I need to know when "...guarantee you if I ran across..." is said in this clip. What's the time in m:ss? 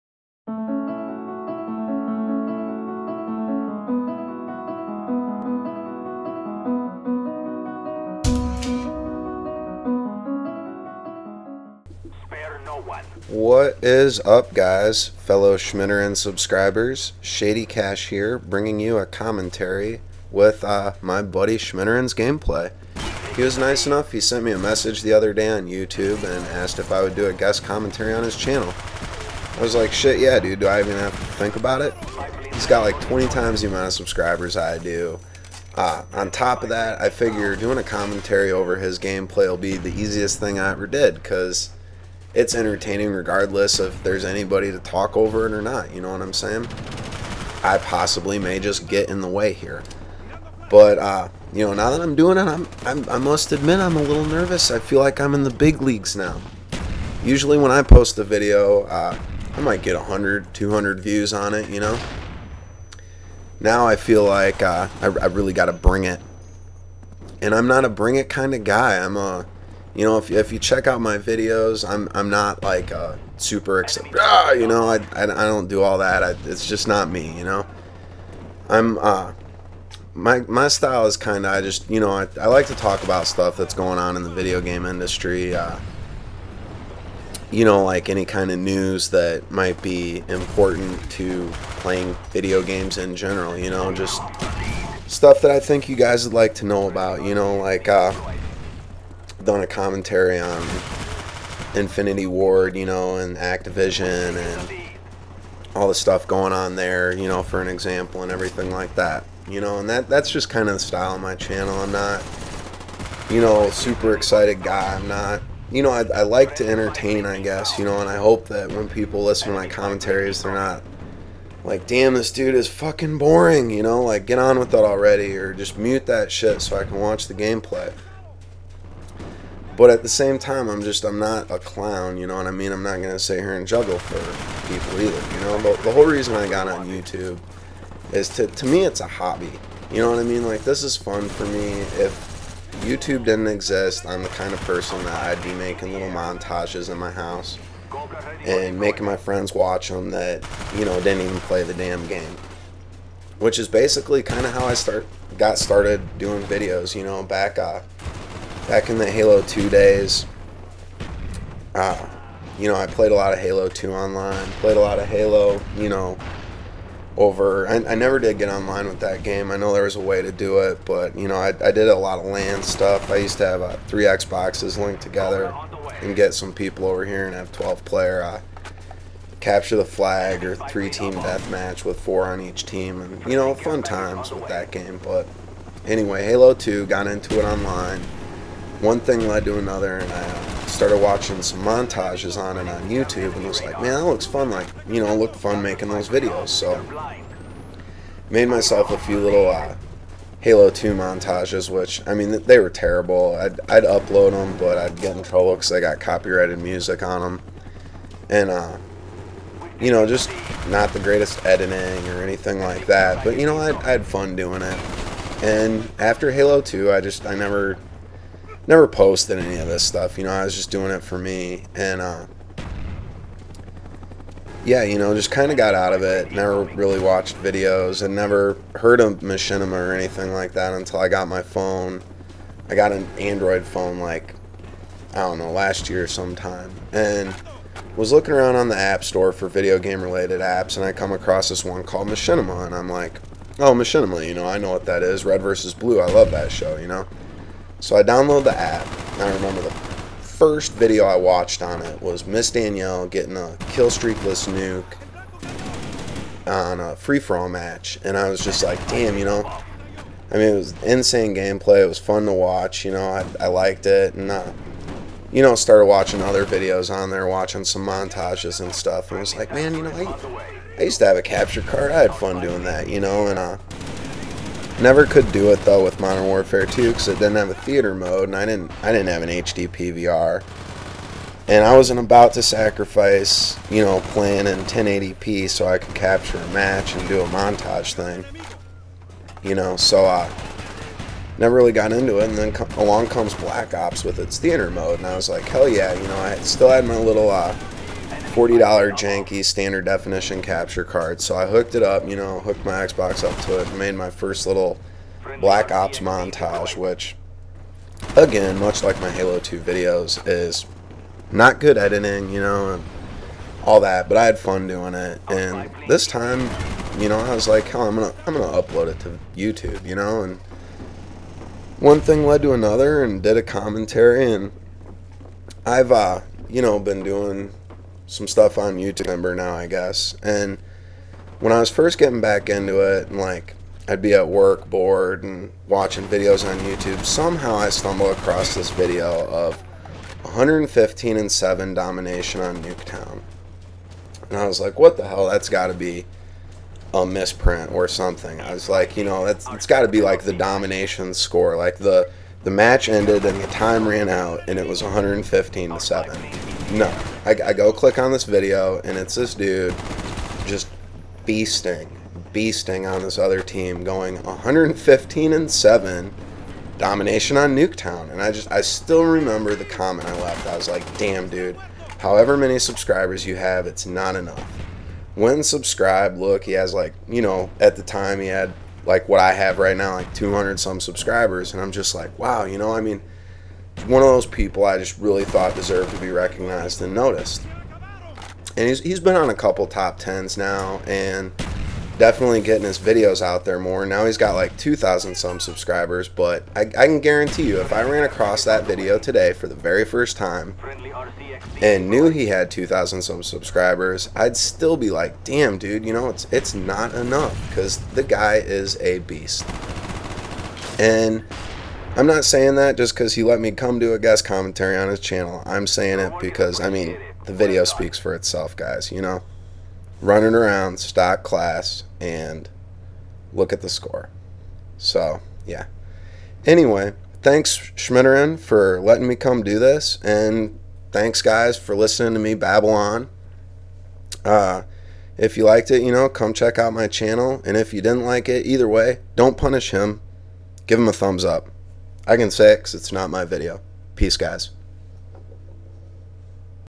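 6:36.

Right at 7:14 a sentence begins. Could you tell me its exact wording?
Uh, if you liked it, you know, come check out my channel.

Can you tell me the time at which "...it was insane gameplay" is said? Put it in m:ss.
4:20.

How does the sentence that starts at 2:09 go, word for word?
But at the same time, I'm just, I'm not a clown, you know what I mean?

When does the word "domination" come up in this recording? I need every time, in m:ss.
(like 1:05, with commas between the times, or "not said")
5:41, 5:50, 6:06.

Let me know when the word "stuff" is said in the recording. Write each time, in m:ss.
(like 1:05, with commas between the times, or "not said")
1:23, 1:35, 1:45, 2:52, 3:39, 4:28, 5:28.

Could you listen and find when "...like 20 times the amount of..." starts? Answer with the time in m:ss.
0:32.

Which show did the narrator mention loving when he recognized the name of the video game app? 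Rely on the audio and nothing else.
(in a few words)
Red versus Blue.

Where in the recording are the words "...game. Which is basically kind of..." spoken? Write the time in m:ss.
2:32.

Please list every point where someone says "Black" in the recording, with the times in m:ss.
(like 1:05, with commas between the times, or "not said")
4:53, 5:05.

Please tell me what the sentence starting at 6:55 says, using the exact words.
I'm saying it because, I mean, the video speaks for itself, guys, you know?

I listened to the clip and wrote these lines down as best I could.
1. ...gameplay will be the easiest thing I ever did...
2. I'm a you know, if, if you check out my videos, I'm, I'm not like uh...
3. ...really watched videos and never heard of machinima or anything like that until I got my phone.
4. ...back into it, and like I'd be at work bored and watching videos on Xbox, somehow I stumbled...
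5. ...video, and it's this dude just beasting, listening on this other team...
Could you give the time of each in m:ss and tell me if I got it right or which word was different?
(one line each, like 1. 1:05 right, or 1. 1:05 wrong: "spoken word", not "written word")
1. 0:38 right
2. 1:09 right
3. 3:46 right
4. 5:32 wrong: "YouTube", not "Xbox"
5. 5:58 wrong: "beasting", not "listening".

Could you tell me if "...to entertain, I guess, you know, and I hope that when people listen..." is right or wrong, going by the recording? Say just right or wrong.
right.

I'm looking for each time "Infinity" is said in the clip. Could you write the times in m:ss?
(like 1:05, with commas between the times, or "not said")
1:41.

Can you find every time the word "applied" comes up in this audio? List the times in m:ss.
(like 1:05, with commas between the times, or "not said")
not said.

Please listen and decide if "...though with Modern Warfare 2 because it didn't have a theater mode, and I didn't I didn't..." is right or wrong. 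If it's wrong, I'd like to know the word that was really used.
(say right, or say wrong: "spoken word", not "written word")
right.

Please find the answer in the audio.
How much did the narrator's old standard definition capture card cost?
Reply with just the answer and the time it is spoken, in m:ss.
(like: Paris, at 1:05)
$40, at 4:58.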